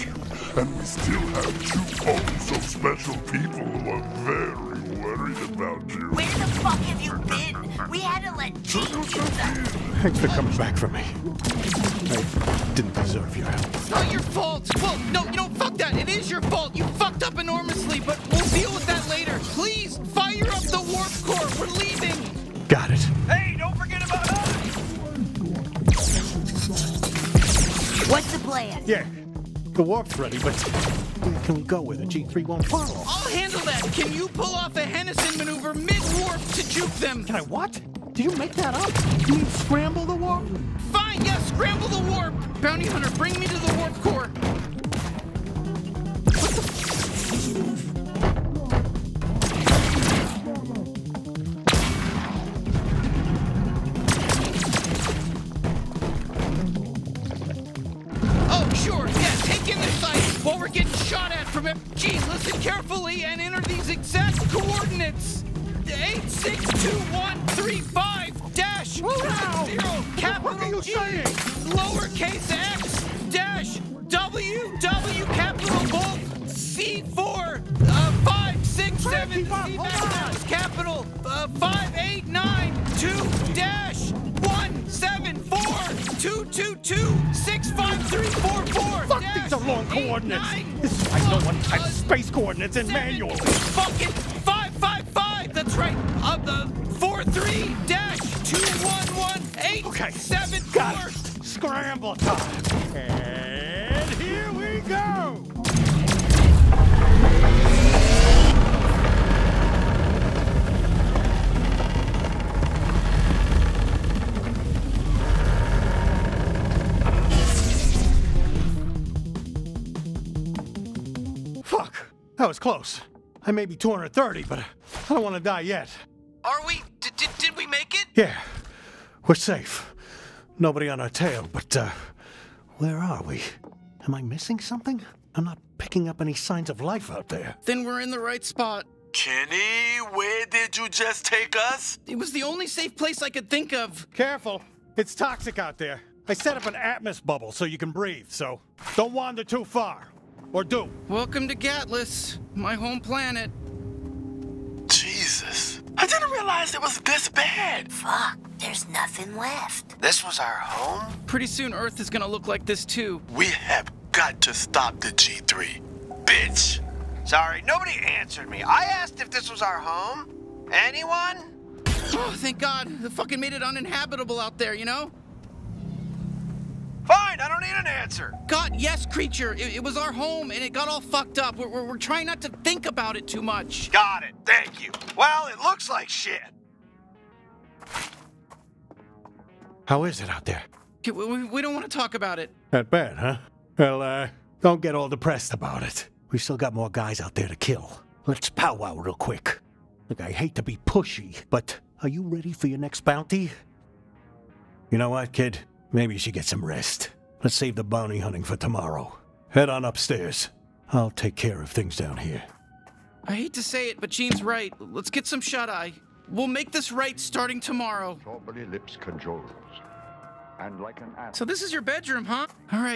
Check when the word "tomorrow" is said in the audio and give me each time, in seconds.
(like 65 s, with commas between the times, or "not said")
208 s, 217 s.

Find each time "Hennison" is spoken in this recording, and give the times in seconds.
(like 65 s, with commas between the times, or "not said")
34 s.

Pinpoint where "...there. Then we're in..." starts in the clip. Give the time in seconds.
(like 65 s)
137 s.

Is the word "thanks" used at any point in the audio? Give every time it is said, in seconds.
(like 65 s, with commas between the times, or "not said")
10 s, 172 s, 184 s.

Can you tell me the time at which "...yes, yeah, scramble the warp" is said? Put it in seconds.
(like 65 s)
41 s.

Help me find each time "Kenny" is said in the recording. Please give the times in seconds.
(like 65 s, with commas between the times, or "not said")
139 s.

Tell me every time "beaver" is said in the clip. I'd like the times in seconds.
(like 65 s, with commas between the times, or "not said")
not said.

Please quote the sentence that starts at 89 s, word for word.
Fuck these are long eight, coordinates.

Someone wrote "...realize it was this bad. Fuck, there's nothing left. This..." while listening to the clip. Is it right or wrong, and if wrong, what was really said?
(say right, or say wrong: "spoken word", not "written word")
right.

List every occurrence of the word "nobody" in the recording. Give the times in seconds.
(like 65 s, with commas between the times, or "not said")
130 s, 167 s.